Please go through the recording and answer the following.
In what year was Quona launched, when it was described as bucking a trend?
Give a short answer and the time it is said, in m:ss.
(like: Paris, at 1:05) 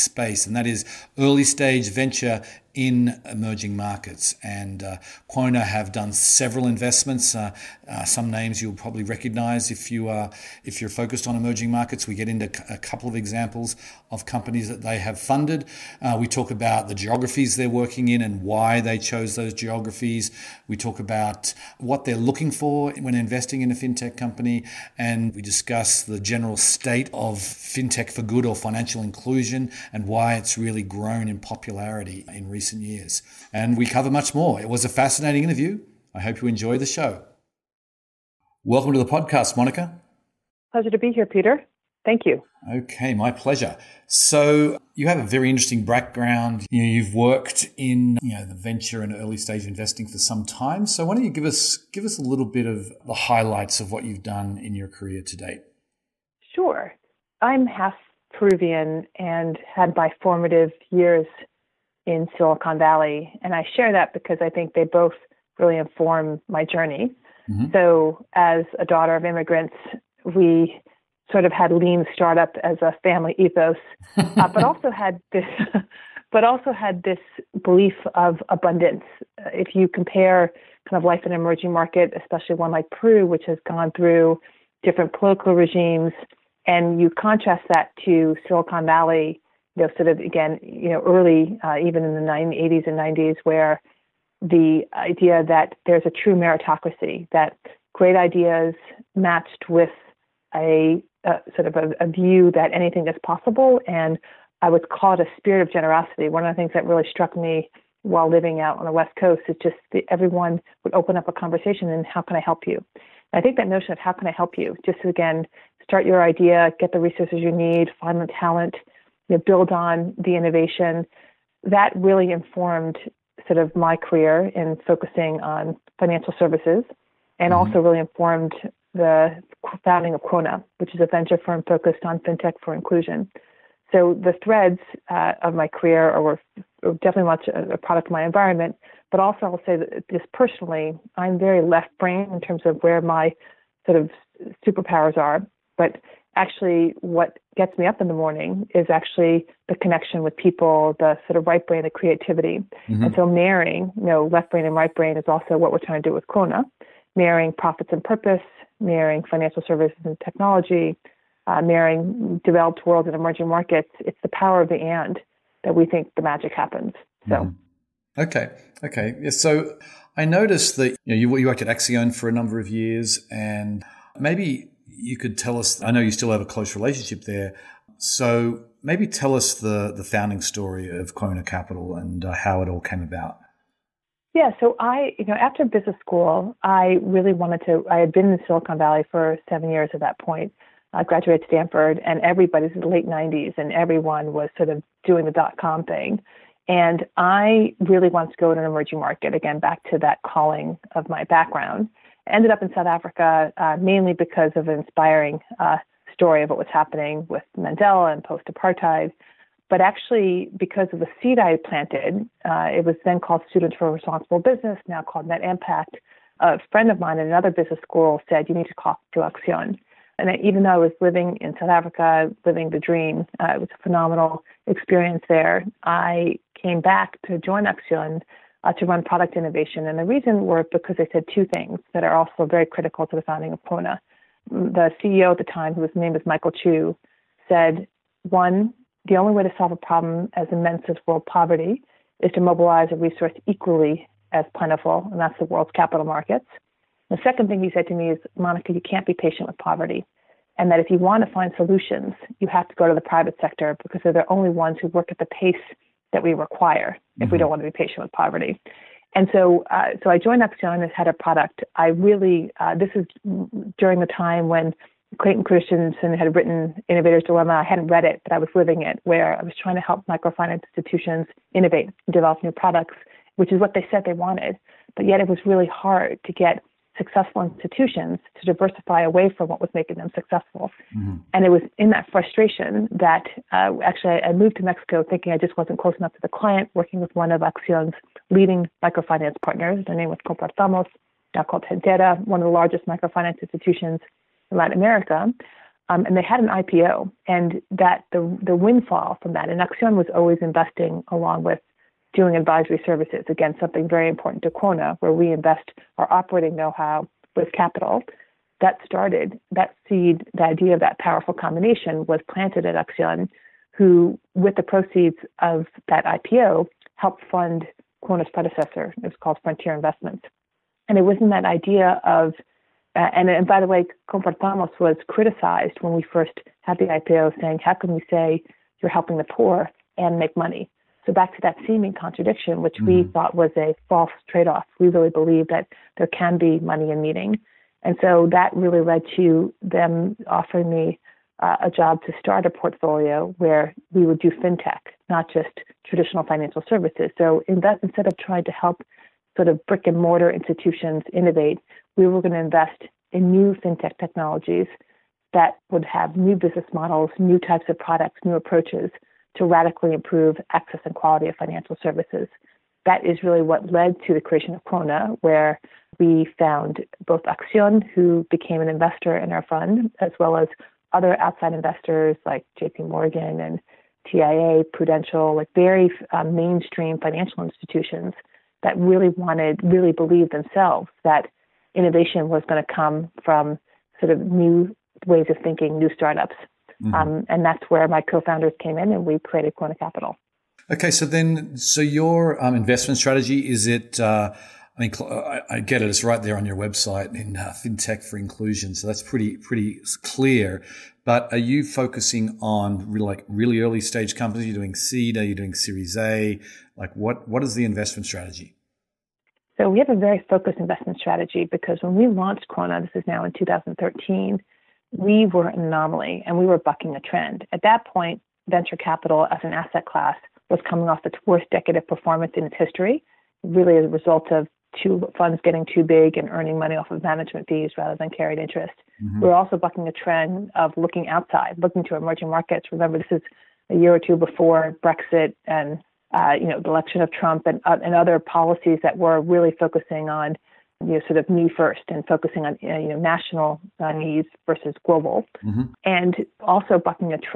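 2013, at 6:53.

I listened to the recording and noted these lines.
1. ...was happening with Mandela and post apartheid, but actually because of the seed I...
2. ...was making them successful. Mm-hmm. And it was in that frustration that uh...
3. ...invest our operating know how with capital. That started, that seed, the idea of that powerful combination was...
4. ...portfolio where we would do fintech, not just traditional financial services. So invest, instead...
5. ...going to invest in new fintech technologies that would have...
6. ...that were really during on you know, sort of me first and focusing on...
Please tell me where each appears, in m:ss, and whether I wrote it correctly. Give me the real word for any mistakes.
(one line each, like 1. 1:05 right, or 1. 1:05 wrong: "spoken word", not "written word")
1. 3:26 right
2. 4:39 right
3. 5:05 right
4. 5:42 right
5. 5:52 right
6. 7:18 wrong: "focusing", not "during".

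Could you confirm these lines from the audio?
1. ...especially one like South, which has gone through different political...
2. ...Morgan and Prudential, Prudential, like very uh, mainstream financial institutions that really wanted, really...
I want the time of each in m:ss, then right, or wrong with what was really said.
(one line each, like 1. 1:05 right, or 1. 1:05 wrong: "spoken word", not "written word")
1. 1:22 wrong: "Peru", not "South"
2. 6:12 wrong: "TIA", not "Prudential".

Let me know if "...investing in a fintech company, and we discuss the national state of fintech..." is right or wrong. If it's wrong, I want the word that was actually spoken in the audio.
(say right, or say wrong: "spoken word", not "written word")
wrong: "general", not "national".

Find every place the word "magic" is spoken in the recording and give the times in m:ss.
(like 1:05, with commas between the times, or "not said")
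2:46.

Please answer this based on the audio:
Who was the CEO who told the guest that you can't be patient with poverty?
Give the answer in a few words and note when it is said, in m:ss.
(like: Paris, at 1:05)
Michael Chu, at 3:56.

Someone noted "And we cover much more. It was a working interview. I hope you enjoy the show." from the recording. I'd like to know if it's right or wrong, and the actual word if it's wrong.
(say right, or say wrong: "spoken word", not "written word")
wrong: "fascinating", not "working".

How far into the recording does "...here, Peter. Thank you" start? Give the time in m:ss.
0:41.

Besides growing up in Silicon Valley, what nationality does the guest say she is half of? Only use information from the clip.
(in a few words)
Peruvian.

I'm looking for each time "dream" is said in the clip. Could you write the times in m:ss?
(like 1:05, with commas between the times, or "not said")
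3:42.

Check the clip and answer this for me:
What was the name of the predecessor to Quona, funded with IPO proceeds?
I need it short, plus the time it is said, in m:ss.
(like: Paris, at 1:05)
Frontier Investments, at 5:19.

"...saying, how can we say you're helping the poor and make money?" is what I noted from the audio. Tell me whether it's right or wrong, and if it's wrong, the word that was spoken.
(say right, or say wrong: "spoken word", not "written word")
right.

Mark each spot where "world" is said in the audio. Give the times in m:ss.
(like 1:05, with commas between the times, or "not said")
2:42, 4:01, 4:05.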